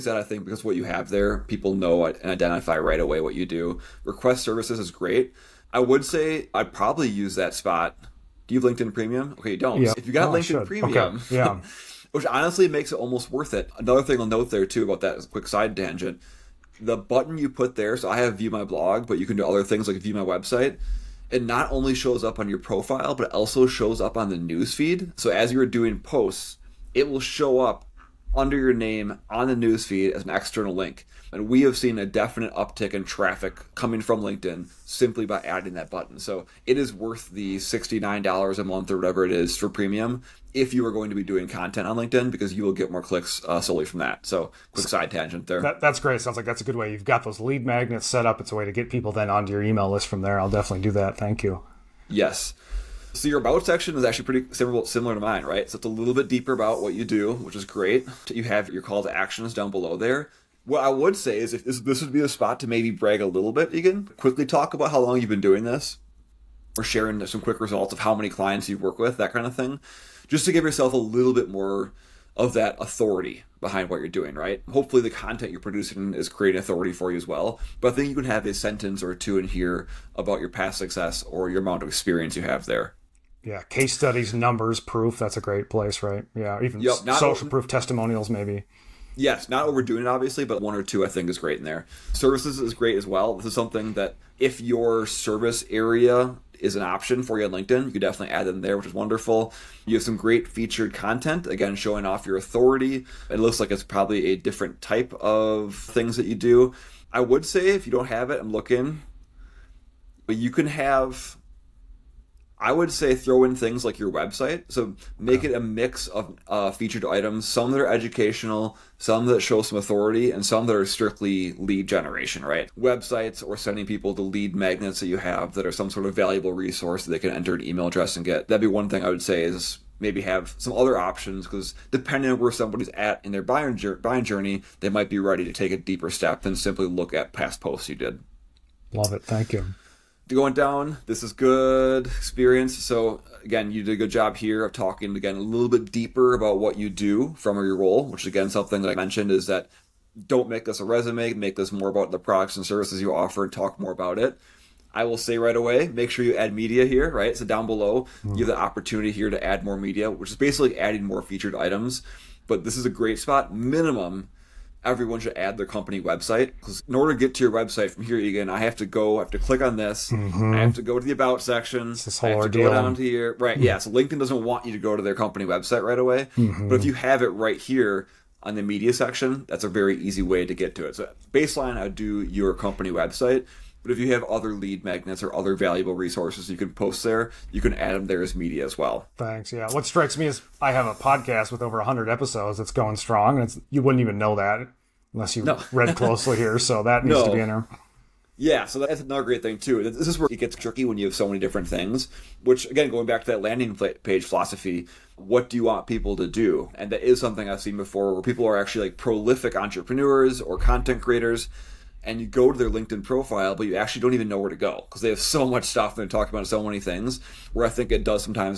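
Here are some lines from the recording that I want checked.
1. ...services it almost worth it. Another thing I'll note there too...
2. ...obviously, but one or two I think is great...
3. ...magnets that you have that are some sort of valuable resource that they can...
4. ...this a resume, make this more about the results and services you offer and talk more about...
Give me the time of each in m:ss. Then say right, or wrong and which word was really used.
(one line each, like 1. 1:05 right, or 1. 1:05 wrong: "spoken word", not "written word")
1. 0:12 wrong: "makes", not "services"
2. 1:30 right
3. 2:04 right
4. 2:30 wrong: "products", not "results".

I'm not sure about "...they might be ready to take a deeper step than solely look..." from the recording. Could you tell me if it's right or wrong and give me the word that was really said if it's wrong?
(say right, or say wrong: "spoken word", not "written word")
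wrong: "simply", not "solely".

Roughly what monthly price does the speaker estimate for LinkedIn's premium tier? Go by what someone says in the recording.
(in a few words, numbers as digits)
$69.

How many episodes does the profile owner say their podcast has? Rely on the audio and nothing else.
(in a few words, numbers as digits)
over 100.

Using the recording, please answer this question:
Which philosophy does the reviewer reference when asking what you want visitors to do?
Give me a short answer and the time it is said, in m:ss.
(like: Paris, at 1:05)
landing page philosophy, at 3:23.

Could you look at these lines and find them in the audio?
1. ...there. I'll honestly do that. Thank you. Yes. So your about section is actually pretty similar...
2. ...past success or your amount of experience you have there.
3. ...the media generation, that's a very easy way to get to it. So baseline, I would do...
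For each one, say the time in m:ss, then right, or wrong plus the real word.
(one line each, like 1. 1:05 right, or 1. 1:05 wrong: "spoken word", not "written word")
1. 0:50 wrong: "definitely", not "honestly"
2. 1:20 right
3. 2:58 wrong: "section", not "generation".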